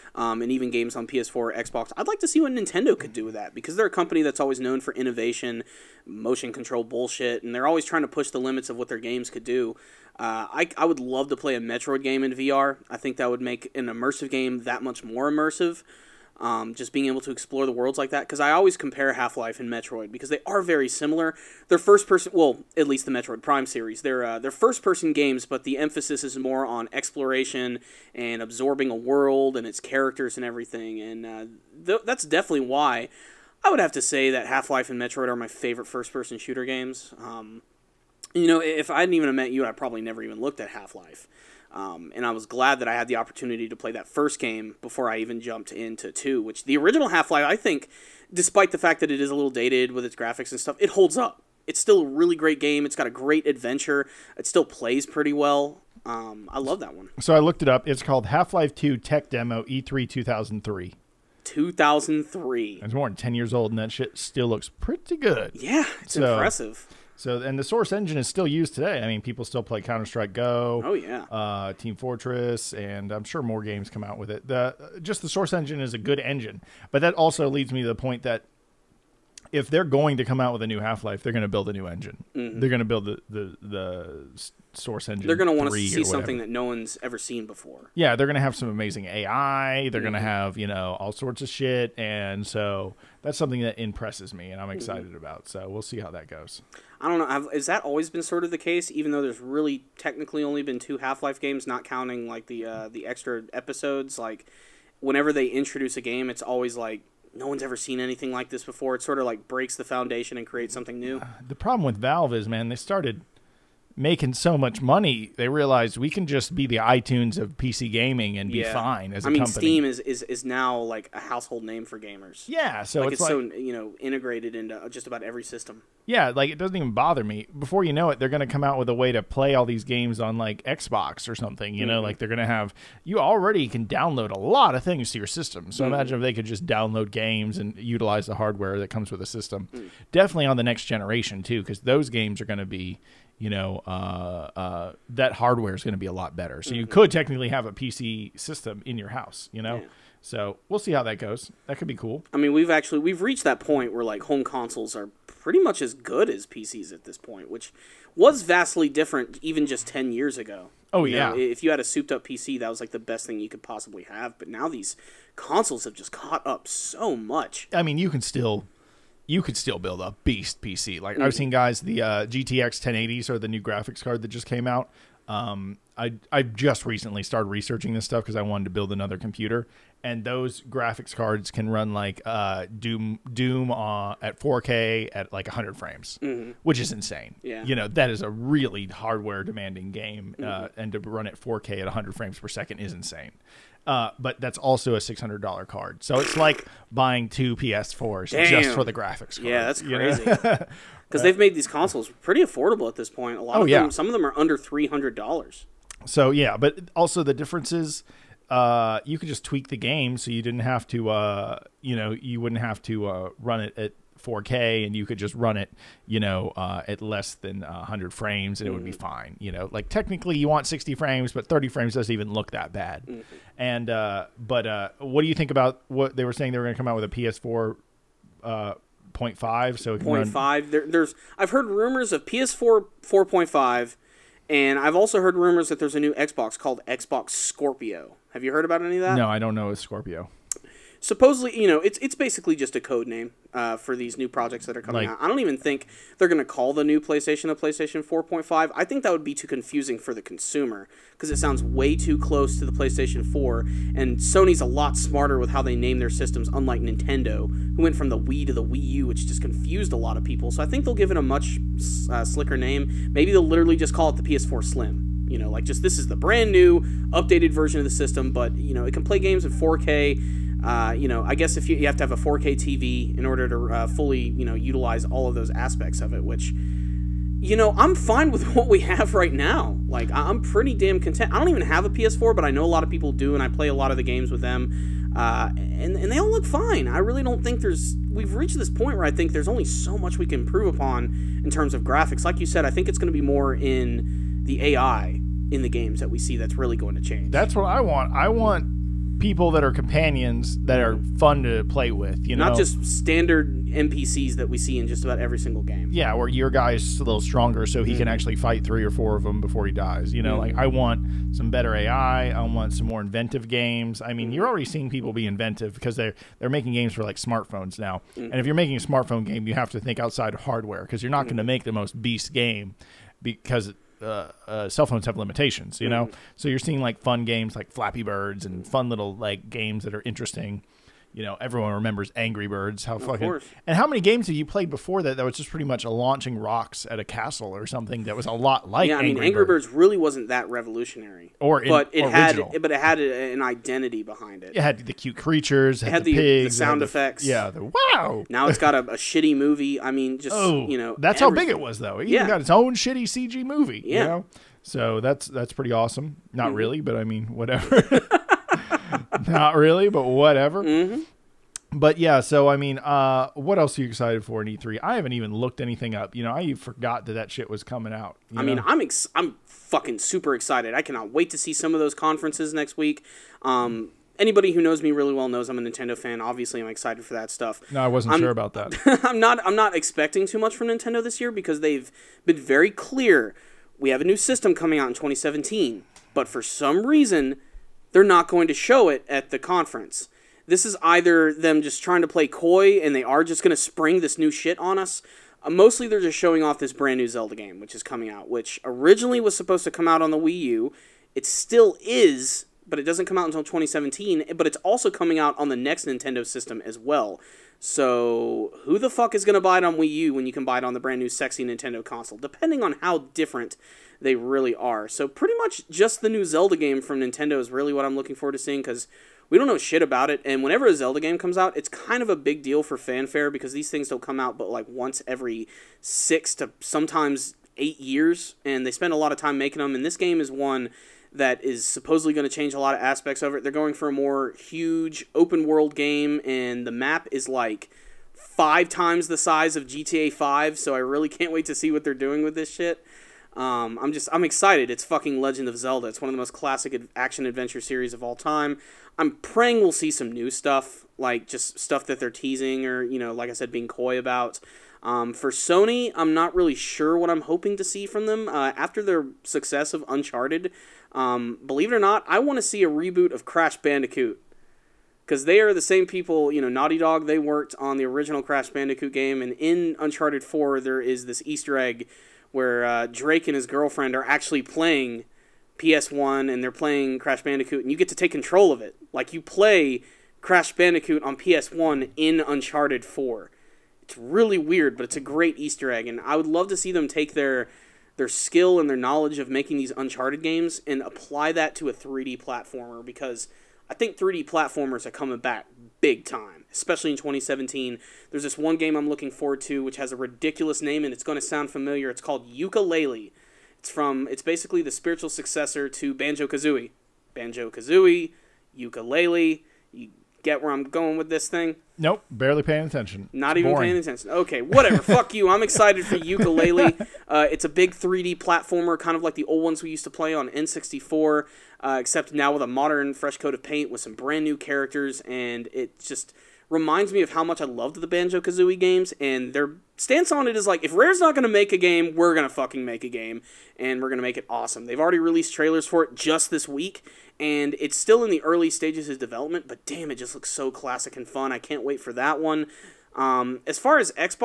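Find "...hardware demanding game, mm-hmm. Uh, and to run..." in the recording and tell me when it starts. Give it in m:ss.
3:08.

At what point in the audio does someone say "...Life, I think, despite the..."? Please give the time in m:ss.
0:47.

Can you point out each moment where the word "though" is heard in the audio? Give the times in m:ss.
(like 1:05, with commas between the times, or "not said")
1:39, 5:51.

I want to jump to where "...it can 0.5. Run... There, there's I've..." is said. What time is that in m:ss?
3:49.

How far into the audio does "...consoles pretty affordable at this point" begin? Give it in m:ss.
3:21.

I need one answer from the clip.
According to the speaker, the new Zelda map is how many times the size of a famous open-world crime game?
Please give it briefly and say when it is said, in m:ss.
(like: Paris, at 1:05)
5 times, at 7:18.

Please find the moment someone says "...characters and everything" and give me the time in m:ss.
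0:29.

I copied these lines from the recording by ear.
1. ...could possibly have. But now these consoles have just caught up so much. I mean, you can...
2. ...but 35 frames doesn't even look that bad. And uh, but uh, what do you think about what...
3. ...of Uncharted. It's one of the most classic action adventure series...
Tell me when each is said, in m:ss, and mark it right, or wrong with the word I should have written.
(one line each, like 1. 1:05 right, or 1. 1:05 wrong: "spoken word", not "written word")
1. 2:43 right
2. 3:41 wrong: "30", not "35"
3. 7:25 wrong: "Zelda", not "Uncharted".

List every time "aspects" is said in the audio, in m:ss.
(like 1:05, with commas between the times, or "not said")
4:35, 7:12.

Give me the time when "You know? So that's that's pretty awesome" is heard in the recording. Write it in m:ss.
5:54.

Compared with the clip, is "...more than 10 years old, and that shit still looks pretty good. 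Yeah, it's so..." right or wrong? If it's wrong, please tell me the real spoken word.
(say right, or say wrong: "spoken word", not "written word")
right.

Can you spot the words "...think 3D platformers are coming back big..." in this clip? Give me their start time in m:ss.
8:13.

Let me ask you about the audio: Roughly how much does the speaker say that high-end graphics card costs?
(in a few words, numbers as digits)
$600.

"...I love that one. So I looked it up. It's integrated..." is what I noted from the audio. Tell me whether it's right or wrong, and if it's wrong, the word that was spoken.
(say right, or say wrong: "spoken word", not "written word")
wrong: "called", not "integrated".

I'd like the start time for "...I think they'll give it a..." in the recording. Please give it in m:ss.
4:20.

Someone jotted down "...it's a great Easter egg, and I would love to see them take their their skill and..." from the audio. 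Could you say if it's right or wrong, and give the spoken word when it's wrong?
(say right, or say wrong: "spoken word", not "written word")
right.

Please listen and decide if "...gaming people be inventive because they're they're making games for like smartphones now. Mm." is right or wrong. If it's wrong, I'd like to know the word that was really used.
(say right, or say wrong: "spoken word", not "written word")
wrong: "seeing", not "gaming".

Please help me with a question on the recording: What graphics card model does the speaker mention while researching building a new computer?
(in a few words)
GTX 1080.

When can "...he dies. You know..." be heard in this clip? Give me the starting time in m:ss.
5:09.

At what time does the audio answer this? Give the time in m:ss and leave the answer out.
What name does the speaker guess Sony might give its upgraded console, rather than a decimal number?
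4:24.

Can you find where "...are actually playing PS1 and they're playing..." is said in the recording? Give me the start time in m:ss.
7:53.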